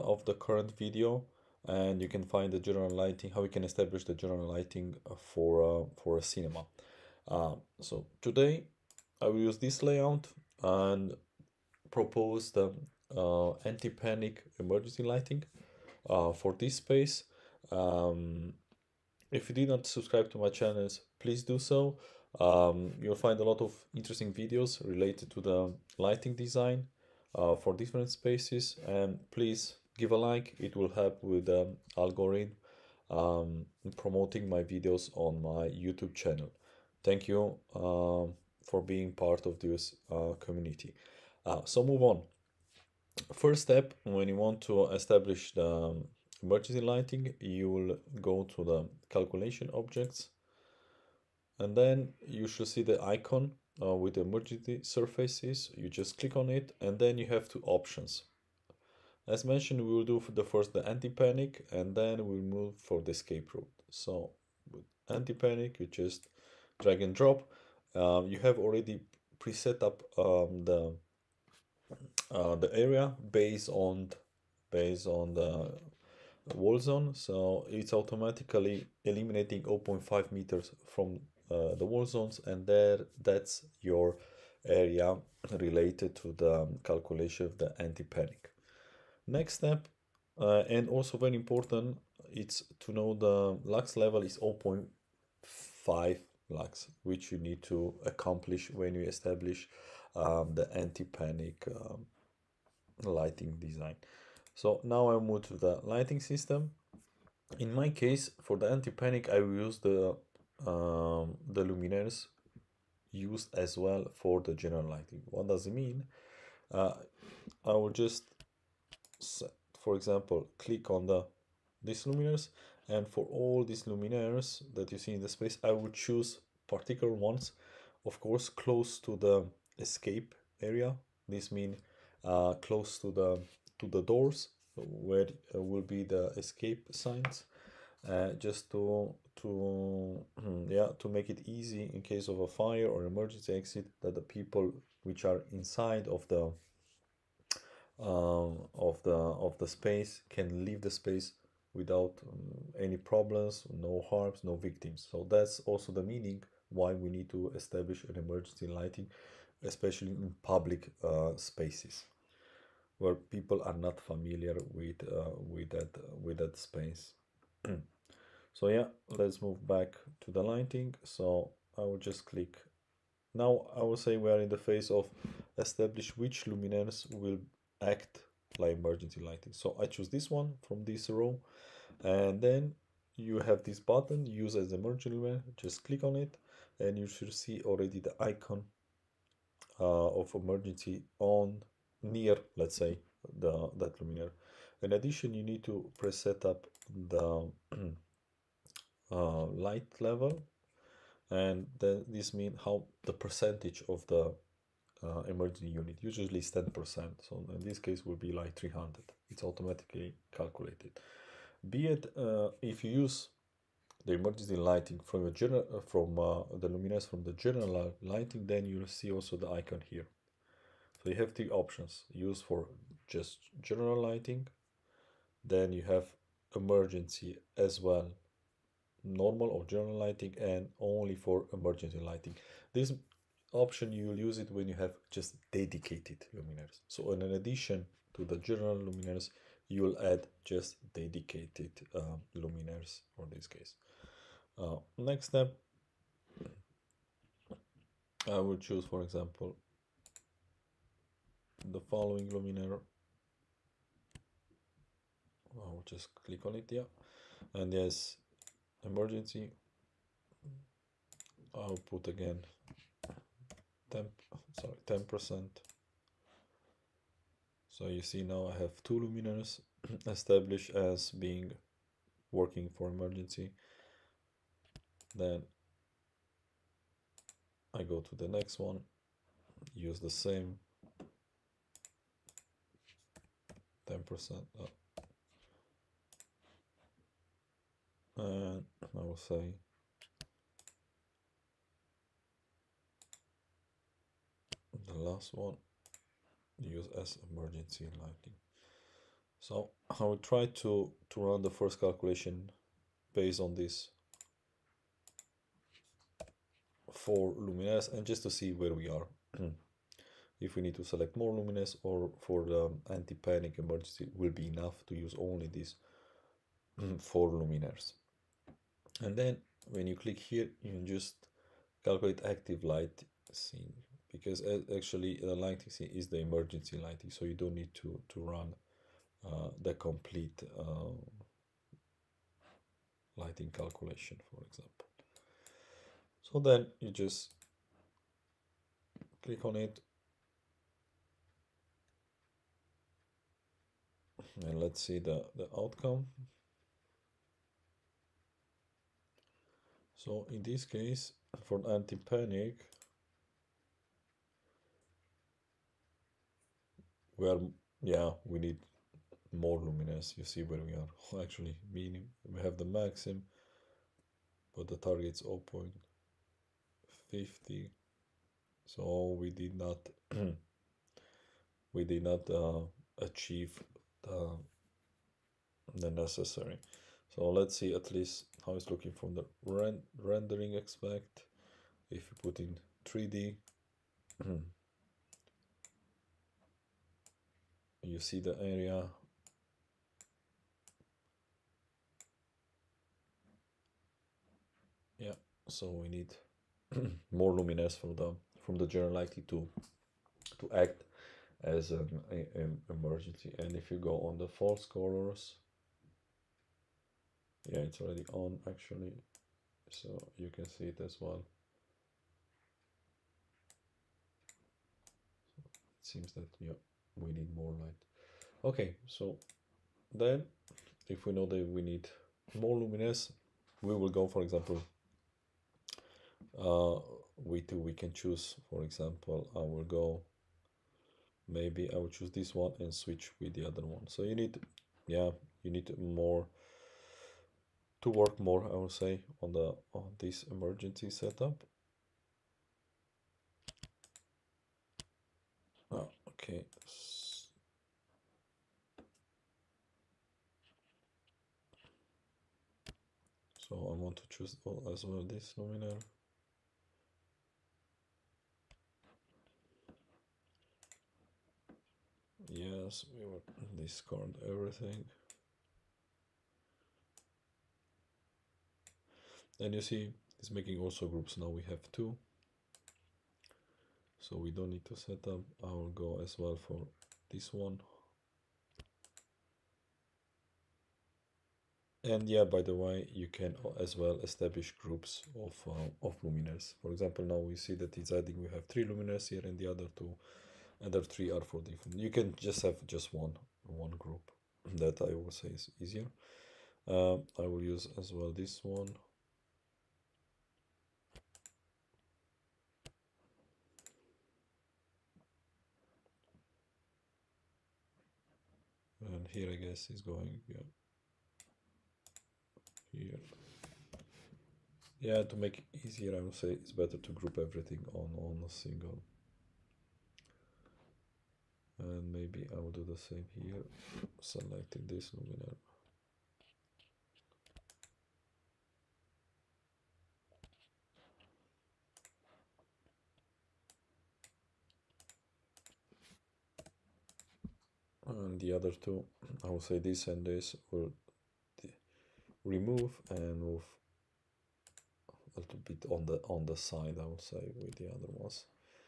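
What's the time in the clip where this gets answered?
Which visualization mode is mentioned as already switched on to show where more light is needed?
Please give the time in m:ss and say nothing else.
6:44.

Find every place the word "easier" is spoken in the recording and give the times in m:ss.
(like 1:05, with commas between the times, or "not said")
8:15, 8:35.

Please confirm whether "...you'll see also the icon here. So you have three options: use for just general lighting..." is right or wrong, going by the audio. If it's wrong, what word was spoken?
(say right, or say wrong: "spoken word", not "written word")
right.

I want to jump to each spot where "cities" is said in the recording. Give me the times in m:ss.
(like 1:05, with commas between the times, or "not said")
not said.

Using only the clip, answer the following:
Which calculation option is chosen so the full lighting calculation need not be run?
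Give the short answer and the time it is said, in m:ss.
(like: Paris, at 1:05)
calculate active light scene, at 5:21.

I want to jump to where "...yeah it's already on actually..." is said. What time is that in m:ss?
6:47.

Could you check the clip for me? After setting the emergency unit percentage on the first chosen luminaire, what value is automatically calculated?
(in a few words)
300.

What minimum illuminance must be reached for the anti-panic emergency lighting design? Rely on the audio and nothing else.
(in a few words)
0.5 lux.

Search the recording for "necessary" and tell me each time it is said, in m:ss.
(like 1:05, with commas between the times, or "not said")
6:15.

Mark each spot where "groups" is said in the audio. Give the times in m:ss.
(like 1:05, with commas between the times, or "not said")
7:50, 8:04, 8:13, 8:36.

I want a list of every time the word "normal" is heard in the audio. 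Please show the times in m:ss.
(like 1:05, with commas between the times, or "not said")
3:49.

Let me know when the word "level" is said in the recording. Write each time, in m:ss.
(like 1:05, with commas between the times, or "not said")
1:33, 3:19.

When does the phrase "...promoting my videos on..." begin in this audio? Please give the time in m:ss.
0:33.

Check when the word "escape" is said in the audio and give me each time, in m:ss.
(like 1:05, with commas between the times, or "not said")
1:03, 2:09, 2:16.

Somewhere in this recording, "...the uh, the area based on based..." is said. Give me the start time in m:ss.
1:10.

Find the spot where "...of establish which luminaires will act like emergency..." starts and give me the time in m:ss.
2:54.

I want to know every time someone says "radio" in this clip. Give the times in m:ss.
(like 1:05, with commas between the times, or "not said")
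not said.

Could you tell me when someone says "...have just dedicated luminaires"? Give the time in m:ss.
3:54.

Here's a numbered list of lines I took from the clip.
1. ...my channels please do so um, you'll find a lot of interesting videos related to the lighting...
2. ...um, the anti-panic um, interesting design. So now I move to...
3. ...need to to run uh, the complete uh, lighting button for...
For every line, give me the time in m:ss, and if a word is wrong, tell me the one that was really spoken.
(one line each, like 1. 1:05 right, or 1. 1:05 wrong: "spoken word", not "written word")
1. 0:20 right
2. 1:40 wrong: "lighting", not "interesting"
3. 5:27 wrong: "calculation", not "button".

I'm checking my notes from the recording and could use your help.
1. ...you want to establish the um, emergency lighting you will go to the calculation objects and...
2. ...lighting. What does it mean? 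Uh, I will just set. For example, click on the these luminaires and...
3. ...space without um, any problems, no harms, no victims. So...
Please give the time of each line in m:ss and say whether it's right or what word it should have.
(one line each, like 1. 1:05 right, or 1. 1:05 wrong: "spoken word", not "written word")
1. 0:44 right
2. 1:54 right
3. 2:30 right.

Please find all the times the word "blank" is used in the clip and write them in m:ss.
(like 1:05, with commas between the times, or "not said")
not said.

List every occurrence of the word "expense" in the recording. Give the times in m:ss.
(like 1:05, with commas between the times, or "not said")
not said.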